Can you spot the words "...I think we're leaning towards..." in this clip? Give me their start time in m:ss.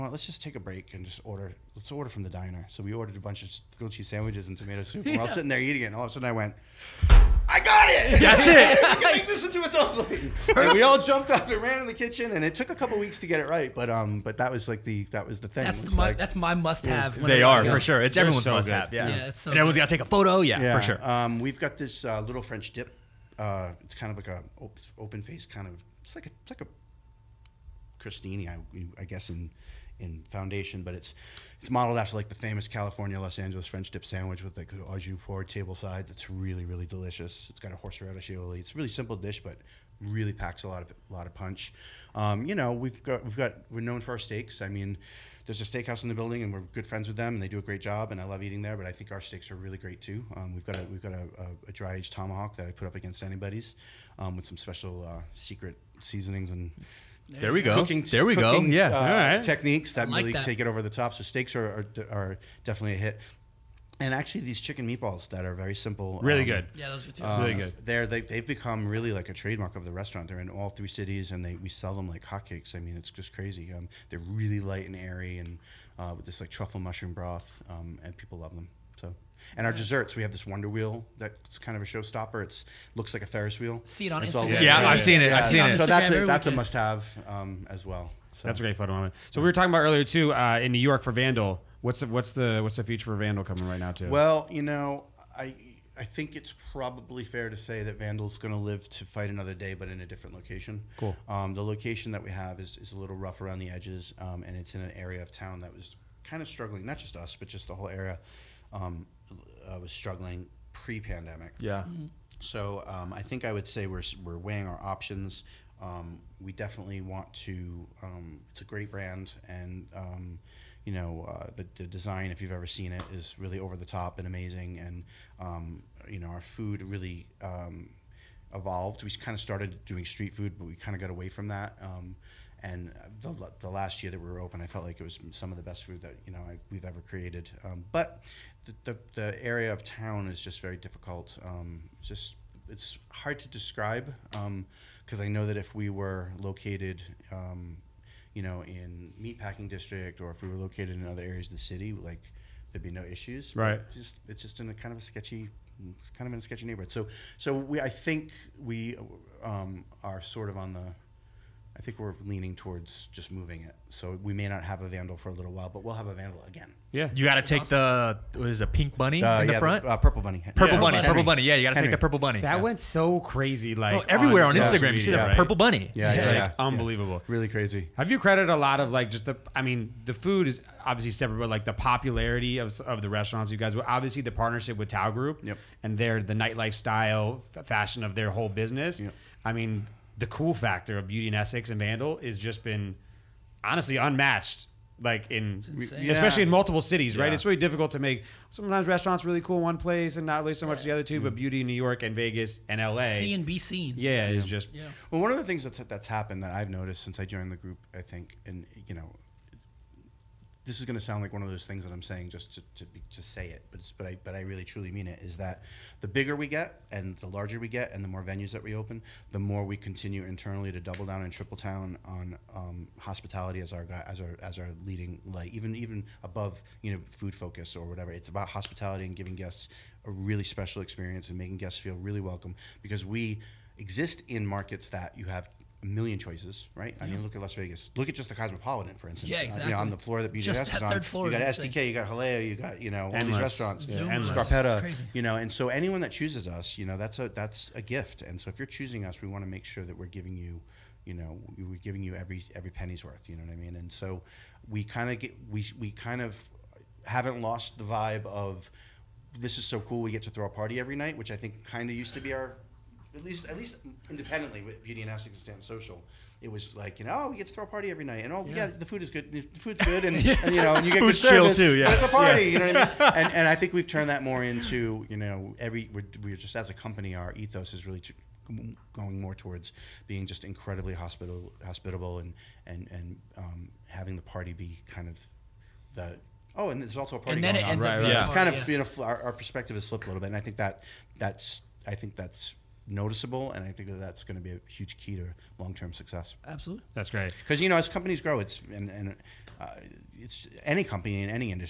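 2:41.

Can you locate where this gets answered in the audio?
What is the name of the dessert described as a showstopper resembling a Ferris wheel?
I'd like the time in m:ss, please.
1:20.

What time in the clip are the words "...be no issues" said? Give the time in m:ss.
2:32.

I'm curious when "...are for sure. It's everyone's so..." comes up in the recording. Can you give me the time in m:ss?
0:17.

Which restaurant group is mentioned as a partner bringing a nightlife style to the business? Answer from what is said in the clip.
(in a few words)
Tao Group.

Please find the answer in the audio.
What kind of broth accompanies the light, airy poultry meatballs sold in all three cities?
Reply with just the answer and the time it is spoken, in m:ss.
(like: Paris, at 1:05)
truffle mushroom broth, at 1:16.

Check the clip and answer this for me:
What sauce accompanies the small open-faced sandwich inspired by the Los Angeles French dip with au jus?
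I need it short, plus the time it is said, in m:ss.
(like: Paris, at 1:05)
horseradish aioli, at 0:37.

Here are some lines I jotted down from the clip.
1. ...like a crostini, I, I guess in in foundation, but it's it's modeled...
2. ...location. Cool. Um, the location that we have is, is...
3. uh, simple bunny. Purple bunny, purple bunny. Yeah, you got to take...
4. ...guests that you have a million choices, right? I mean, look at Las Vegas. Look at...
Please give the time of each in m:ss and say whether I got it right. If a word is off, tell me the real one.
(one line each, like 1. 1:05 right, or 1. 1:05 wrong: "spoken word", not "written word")
1. 0:26 right
2. 1:40 right
3. 2:49 wrong: "purple", not "simple"
4. 3:54 wrong: "markets", not "guests".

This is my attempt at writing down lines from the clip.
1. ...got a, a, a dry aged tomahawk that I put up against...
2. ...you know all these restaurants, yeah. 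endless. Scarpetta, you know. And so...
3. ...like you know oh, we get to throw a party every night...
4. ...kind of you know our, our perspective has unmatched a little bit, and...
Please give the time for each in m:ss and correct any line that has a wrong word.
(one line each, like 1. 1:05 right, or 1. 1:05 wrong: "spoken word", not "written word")
1. 0:51 right
2. 4:02 right
3. 4:26 right
4. 4:48 wrong: "flipped", not "unmatched".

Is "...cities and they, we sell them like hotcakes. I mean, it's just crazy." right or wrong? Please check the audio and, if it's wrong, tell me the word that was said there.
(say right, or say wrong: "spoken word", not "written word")
right.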